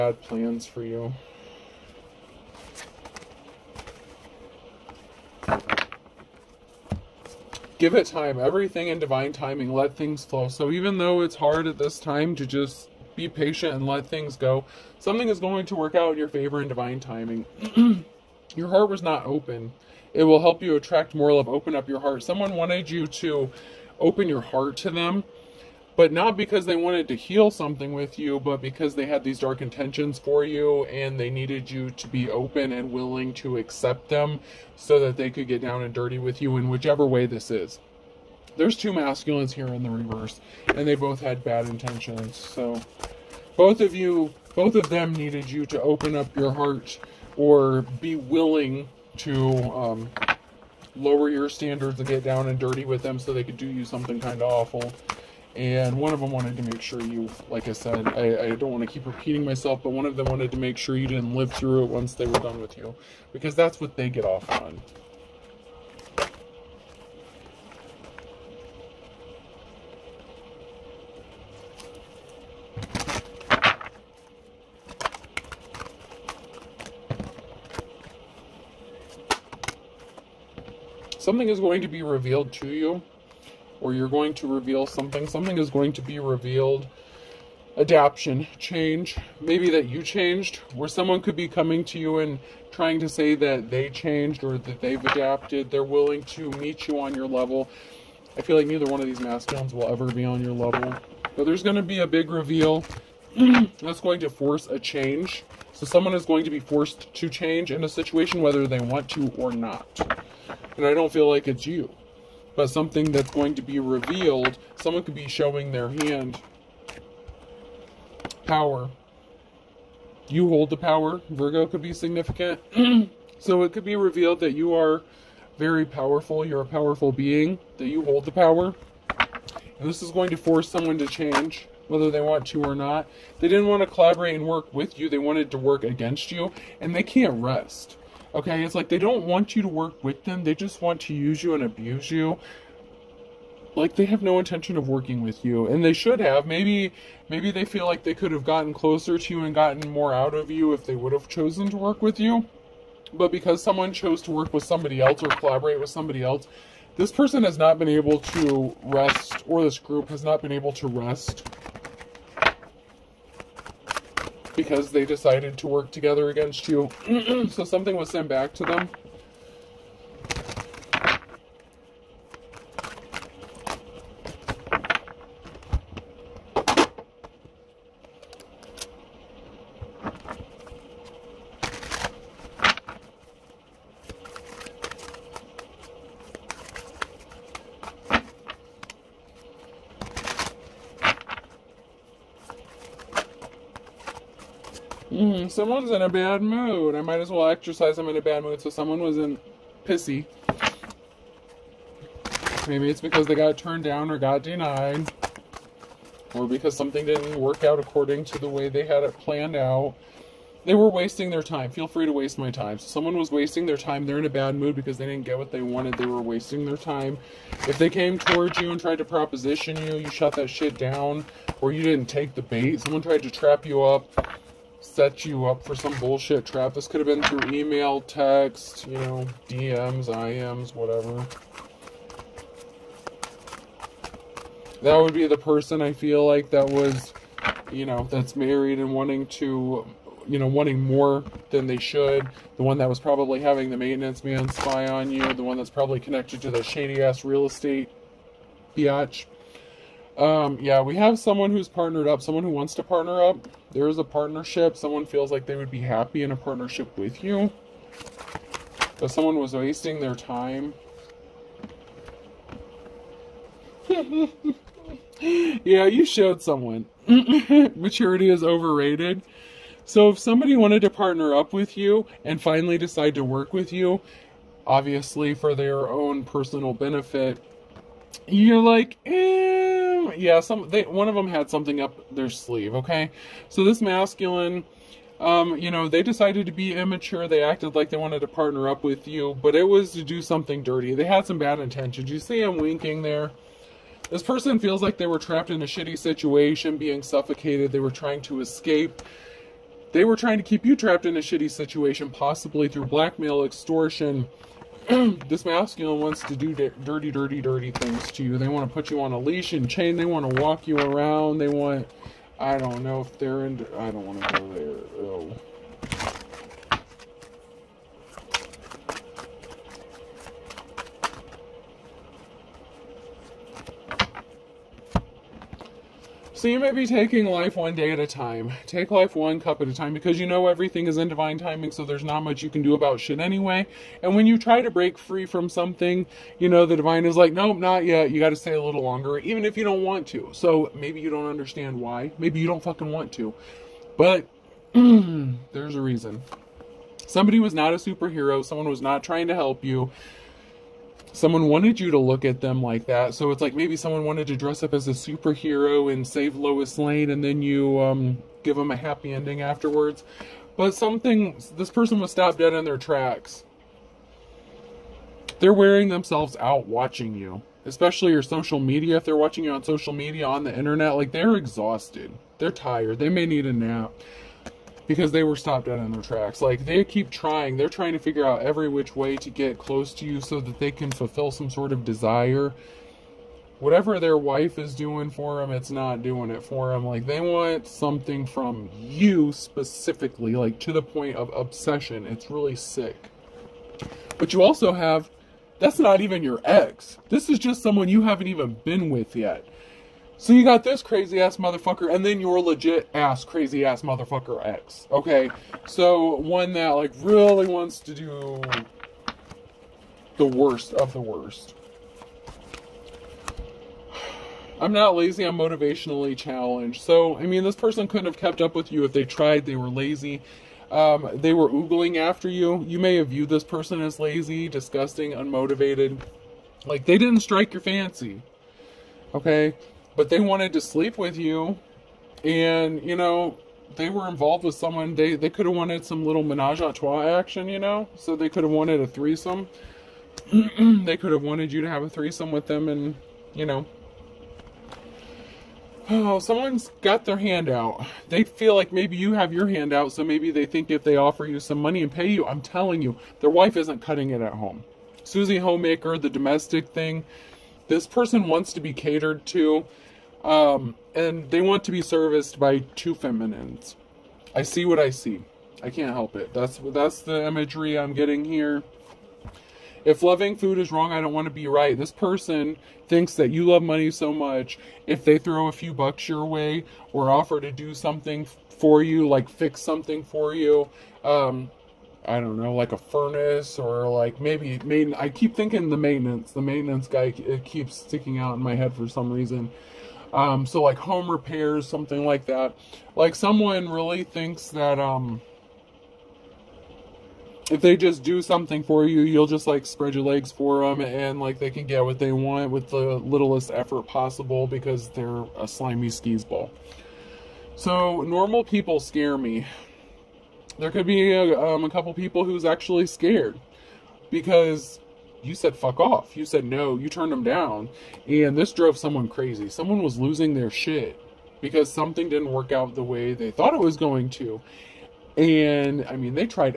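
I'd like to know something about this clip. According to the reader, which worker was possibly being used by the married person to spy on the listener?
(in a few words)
The maintenance man.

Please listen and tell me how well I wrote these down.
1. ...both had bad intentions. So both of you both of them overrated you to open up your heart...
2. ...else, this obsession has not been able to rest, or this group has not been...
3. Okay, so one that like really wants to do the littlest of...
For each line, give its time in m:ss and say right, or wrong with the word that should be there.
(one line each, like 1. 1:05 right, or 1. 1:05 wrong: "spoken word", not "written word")
1. 0:40 wrong: "needed", not "overrated"
2. 2:36 wrong: "person", not "obsession"
3. 6:44 wrong: "worst", not "littlest".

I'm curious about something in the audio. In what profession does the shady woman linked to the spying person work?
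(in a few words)
Real estate.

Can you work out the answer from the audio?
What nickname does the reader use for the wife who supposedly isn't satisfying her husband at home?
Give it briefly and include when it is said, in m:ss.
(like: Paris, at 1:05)
Susie Homemaker, at 7:35.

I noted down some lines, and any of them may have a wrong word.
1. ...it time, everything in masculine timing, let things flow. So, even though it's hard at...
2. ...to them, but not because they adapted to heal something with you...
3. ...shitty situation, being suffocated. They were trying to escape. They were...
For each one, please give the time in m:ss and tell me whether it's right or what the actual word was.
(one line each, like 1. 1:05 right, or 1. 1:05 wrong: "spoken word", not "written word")
1. 0:07 wrong: "divine", not "masculine"
2. 0:24 wrong: "wanted", not "adapted"
3. 4:55 right.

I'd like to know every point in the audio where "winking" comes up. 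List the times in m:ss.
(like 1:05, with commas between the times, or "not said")
4:52.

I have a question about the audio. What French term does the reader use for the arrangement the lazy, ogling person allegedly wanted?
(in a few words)
Menage a trois.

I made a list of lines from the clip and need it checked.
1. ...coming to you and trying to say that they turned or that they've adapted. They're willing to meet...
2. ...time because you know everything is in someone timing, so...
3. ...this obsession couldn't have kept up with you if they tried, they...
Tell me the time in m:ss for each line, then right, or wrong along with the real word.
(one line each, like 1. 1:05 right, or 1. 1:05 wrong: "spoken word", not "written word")
1. 1:31 wrong: "changed", not "turned"
2. 5:29 wrong: "divine", not "someone"
3. 6:57 wrong: "person", not "obsession".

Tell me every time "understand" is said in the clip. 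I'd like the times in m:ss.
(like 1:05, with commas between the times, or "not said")
5:41.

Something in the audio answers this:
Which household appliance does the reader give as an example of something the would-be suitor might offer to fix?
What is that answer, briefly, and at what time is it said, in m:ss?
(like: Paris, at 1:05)
A furnace, at 8:02.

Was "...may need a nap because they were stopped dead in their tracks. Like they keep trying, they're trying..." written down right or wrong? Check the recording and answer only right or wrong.
right.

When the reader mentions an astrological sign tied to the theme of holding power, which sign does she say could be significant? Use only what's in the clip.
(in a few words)
Virgo.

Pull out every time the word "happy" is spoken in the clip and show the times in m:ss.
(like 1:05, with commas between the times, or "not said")
4:15, 5:58.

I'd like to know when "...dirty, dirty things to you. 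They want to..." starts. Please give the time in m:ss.
5:07.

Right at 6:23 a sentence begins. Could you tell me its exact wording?
Whatever their wife is doing for them, it's not doing it for them.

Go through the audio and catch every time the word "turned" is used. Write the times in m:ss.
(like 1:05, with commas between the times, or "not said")
3:23, 8:36.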